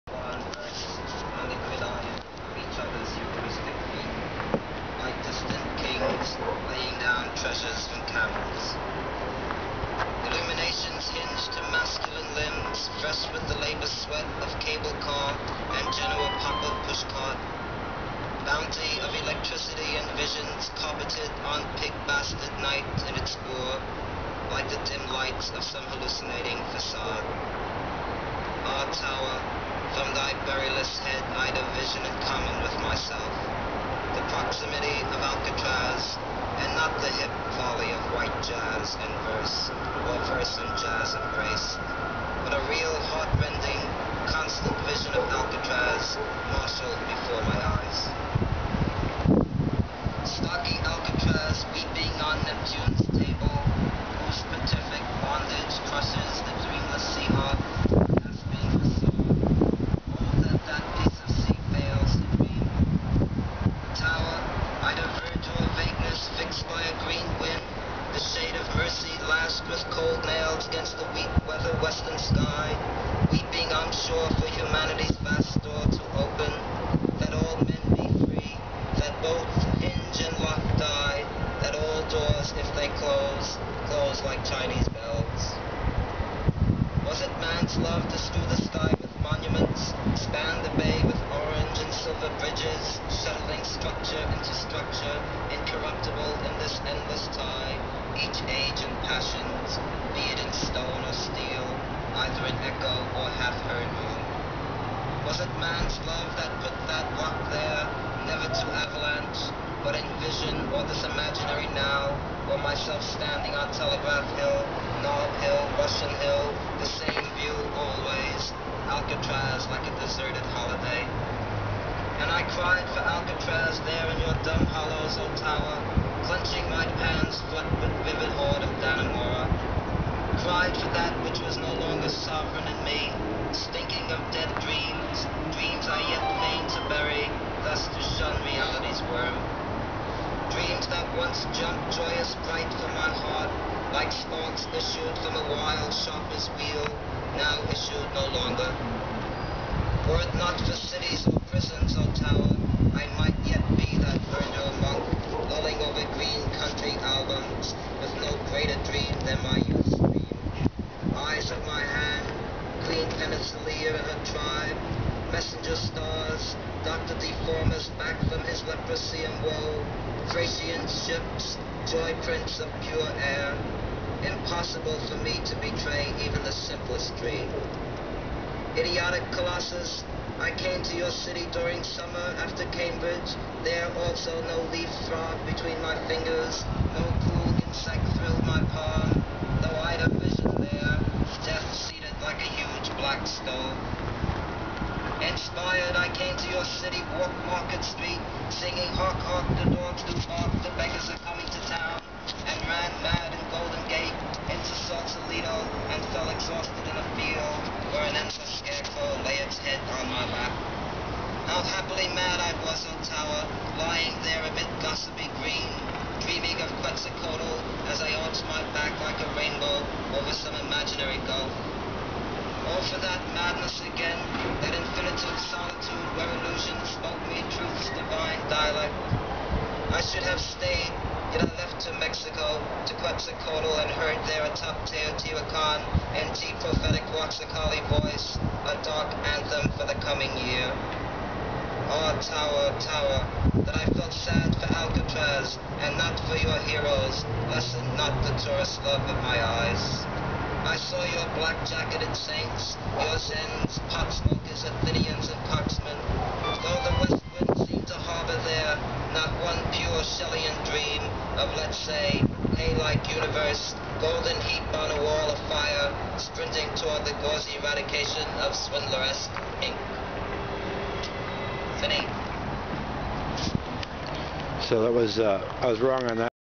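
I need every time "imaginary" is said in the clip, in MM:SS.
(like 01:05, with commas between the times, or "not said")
01:51, 03:40.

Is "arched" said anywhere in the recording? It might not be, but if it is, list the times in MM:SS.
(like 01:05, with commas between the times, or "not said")
03:38.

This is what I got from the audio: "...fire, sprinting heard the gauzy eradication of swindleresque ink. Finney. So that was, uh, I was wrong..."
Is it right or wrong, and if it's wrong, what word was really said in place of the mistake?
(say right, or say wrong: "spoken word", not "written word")
wrong: "toward", not "heard".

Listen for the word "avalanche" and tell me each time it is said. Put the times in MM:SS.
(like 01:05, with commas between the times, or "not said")
01:48.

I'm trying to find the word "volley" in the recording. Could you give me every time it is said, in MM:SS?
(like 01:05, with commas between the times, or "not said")
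00:37.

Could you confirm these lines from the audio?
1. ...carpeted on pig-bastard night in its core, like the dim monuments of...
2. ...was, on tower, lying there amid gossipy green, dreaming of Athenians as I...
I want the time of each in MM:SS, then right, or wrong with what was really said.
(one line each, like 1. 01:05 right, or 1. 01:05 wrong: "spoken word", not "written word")
1. 00:20 wrong: "lights", not "monuments"
2. 03:32 wrong: "Quetzalcoatl", not "Athenians".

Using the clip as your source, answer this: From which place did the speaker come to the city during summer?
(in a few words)
Cambridge.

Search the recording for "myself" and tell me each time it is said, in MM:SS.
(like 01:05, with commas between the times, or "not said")
00:32, 01:52.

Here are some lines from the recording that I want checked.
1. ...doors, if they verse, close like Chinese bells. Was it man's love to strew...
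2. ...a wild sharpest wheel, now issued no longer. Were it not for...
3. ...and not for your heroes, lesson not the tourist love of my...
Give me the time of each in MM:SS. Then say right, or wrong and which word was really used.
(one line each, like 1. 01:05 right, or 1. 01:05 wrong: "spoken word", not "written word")
1. 01:22 wrong: "close", not "verse"
2. 02:25 right
3. 04:05 right.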